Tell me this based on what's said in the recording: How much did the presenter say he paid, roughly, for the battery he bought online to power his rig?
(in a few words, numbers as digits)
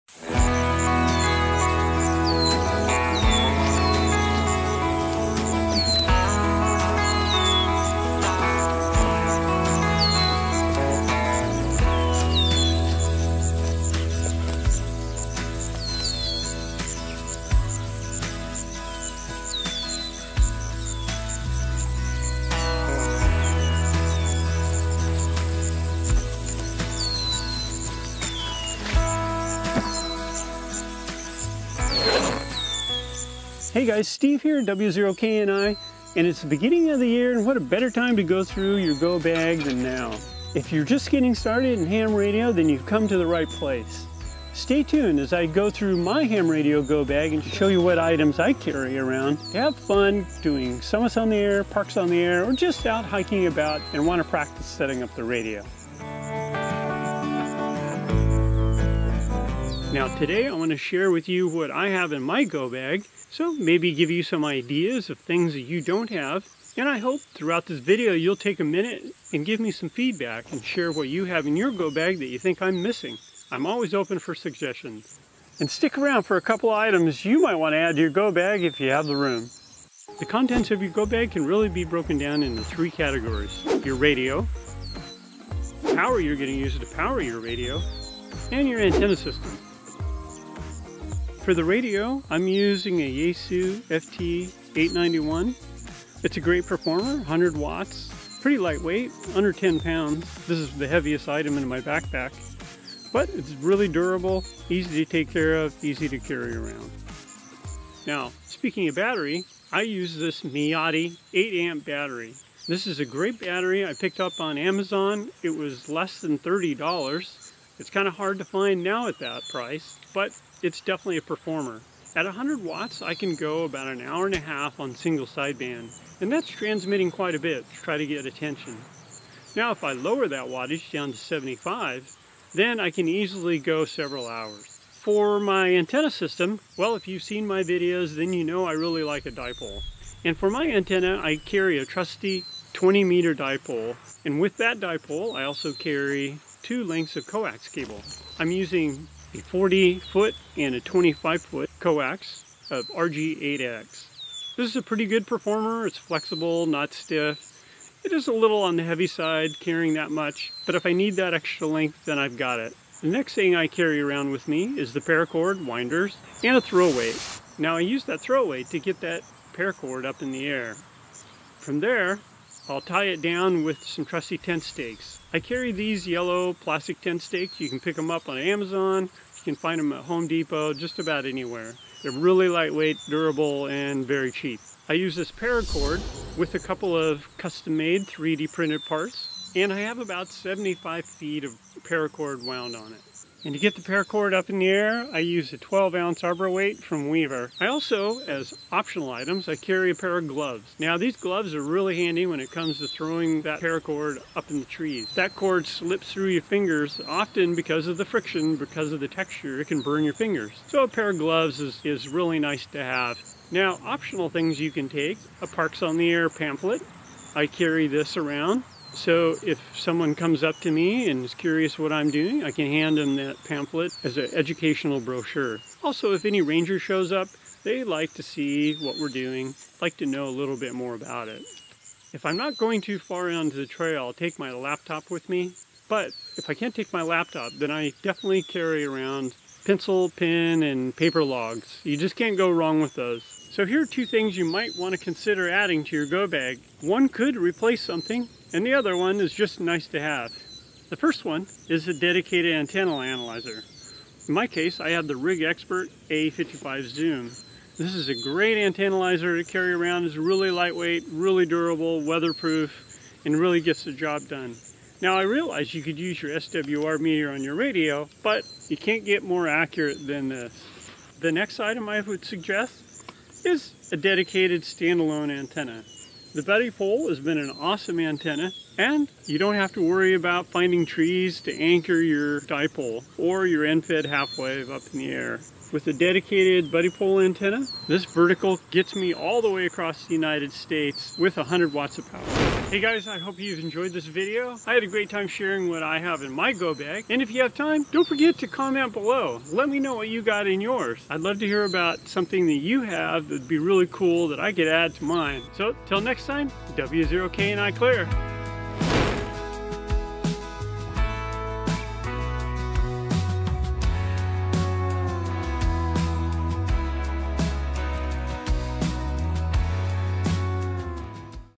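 less than $30.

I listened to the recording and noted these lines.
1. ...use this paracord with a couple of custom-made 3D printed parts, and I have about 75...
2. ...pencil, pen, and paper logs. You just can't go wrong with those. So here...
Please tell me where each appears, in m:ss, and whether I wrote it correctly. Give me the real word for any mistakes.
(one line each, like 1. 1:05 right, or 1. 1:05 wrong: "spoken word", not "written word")
1. 3:04 right
2. 3:59 right.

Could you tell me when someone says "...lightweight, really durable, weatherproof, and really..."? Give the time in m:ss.
4:20.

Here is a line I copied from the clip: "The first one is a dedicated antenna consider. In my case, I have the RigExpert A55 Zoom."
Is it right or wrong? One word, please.
wrong.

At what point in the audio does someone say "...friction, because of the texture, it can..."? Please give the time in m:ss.
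3:28.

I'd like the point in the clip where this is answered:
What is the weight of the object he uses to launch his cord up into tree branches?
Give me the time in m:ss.
3:15.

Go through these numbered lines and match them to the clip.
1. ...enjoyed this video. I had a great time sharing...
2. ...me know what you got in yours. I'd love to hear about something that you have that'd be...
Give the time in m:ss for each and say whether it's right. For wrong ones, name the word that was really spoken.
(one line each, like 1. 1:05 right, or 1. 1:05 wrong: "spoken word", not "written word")
1. 4:53 right
2. 4:59 right.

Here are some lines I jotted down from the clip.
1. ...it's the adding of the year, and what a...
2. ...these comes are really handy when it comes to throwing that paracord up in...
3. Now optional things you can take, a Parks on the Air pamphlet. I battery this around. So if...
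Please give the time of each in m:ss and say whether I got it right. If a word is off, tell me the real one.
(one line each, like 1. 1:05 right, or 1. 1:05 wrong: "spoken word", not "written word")
1. 0:36 wrong: "beginning", not "adding"
2. 3:20 wrong: "gloves", not "comes"
3. 3:33 wrong: "carry", not "battery".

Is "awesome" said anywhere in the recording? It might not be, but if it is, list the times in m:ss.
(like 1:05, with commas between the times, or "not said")
4:37.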